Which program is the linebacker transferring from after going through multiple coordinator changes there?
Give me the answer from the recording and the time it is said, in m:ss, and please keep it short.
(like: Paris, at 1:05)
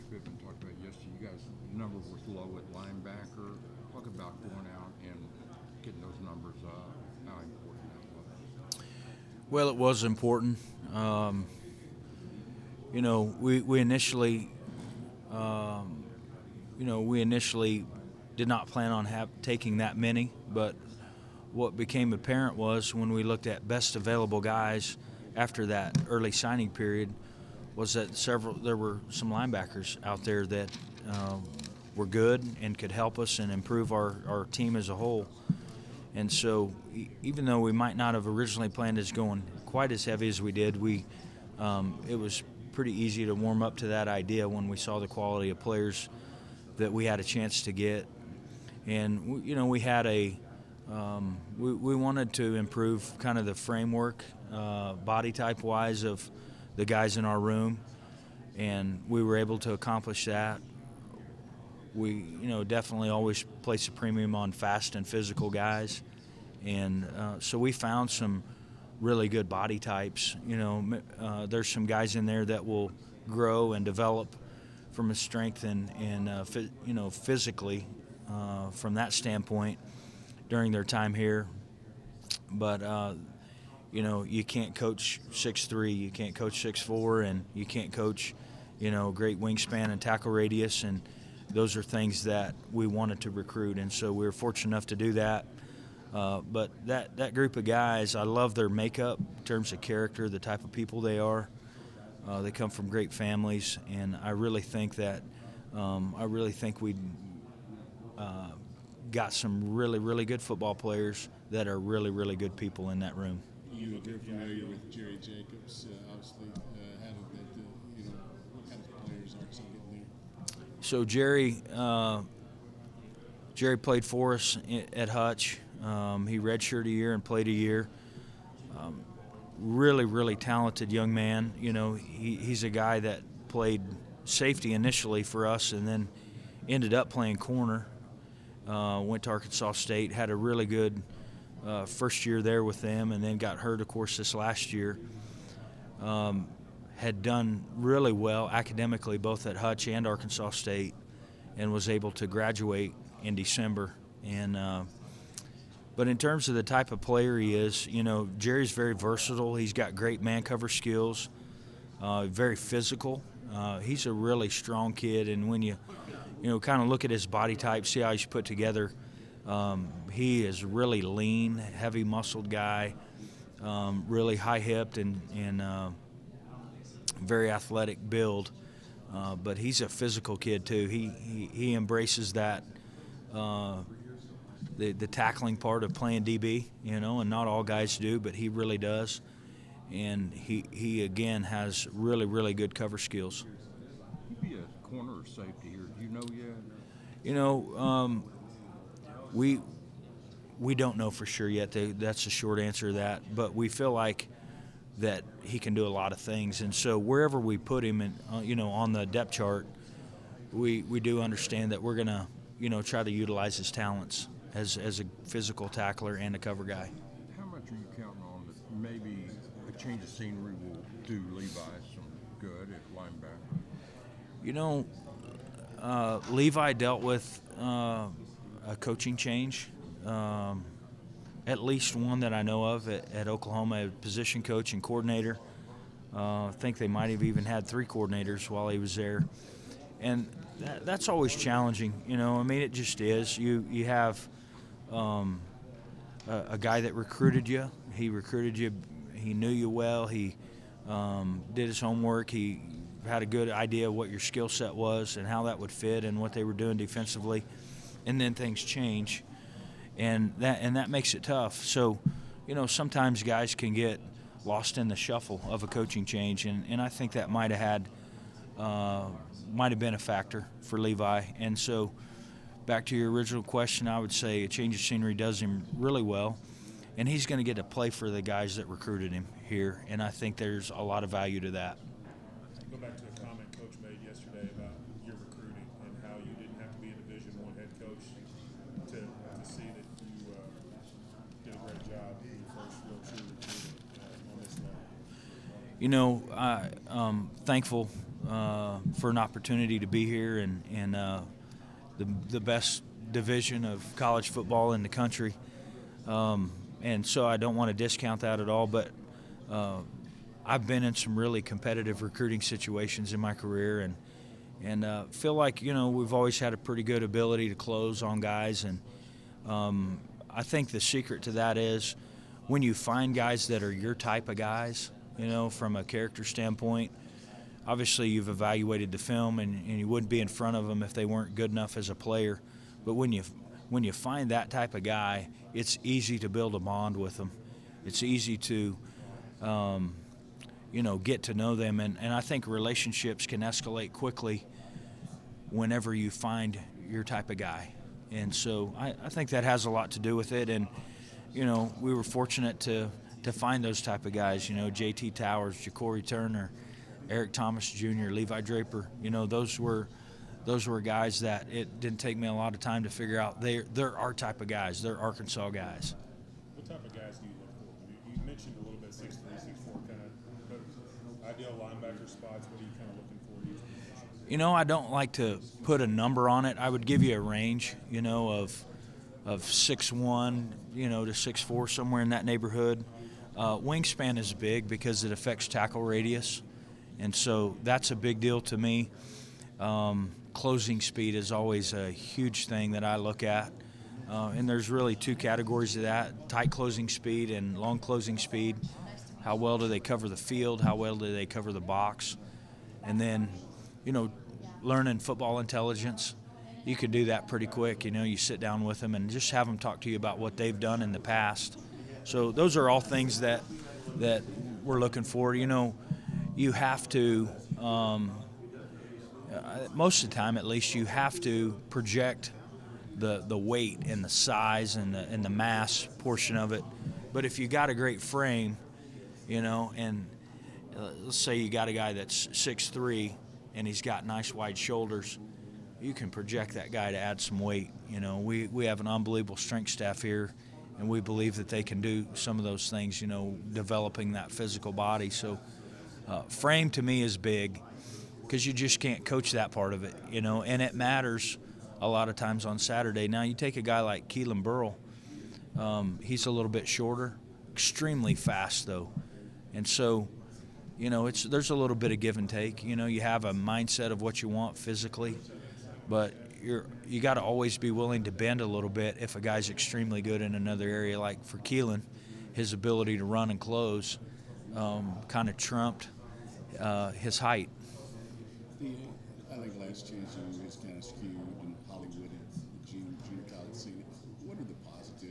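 Oklahoma, at 3:53.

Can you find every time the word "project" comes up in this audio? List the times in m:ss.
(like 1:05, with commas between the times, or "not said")
7:01, 7:16.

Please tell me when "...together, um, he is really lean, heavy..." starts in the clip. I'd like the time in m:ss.
2:48.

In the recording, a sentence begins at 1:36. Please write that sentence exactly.
Uh, but that, that group of guys, I love their makeup in terms of character, the type of people they are.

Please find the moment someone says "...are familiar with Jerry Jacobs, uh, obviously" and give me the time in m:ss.
1:53.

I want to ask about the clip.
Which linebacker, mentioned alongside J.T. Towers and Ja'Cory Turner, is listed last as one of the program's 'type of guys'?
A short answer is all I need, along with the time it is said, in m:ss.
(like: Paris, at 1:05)
Levi Draper, at 5:58.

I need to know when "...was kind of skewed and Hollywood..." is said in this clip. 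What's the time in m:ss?
8:00.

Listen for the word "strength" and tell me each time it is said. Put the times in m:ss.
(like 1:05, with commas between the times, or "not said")
1:15, 7:19.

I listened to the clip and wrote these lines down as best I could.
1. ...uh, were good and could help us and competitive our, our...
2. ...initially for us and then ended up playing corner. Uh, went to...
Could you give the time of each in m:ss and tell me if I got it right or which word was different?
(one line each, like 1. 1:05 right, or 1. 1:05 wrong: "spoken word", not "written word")
1. 0:31 wrong: "improve", not "competitive"
2. 2:14 right.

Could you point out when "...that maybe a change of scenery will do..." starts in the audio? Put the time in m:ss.
3:38.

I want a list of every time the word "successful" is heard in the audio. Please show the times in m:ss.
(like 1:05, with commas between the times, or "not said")
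not said.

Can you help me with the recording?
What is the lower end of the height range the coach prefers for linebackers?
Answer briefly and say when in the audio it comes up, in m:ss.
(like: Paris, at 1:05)
6'1", at 6:19.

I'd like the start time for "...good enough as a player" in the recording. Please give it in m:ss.
5:31.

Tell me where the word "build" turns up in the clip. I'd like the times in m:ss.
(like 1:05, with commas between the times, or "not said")
2:58, 5:36.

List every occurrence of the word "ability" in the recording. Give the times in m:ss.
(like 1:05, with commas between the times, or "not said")
5:17, 7:52.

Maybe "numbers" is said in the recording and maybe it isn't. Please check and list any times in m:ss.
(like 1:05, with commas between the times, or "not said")
0:06, 6:15.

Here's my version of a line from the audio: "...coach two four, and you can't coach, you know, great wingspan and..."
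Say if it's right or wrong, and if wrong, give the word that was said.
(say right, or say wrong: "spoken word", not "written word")
wrong: "six", not "two".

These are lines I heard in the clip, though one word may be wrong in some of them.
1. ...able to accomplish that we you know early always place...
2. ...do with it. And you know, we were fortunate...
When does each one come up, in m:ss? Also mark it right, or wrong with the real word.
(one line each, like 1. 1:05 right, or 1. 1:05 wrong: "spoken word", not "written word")
1. 0:59 wrong: "definitely", not "early"
2. 5:49 right.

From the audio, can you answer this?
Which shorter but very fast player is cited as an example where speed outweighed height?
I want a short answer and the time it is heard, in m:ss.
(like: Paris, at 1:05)
Keelan Burl, at 7:34.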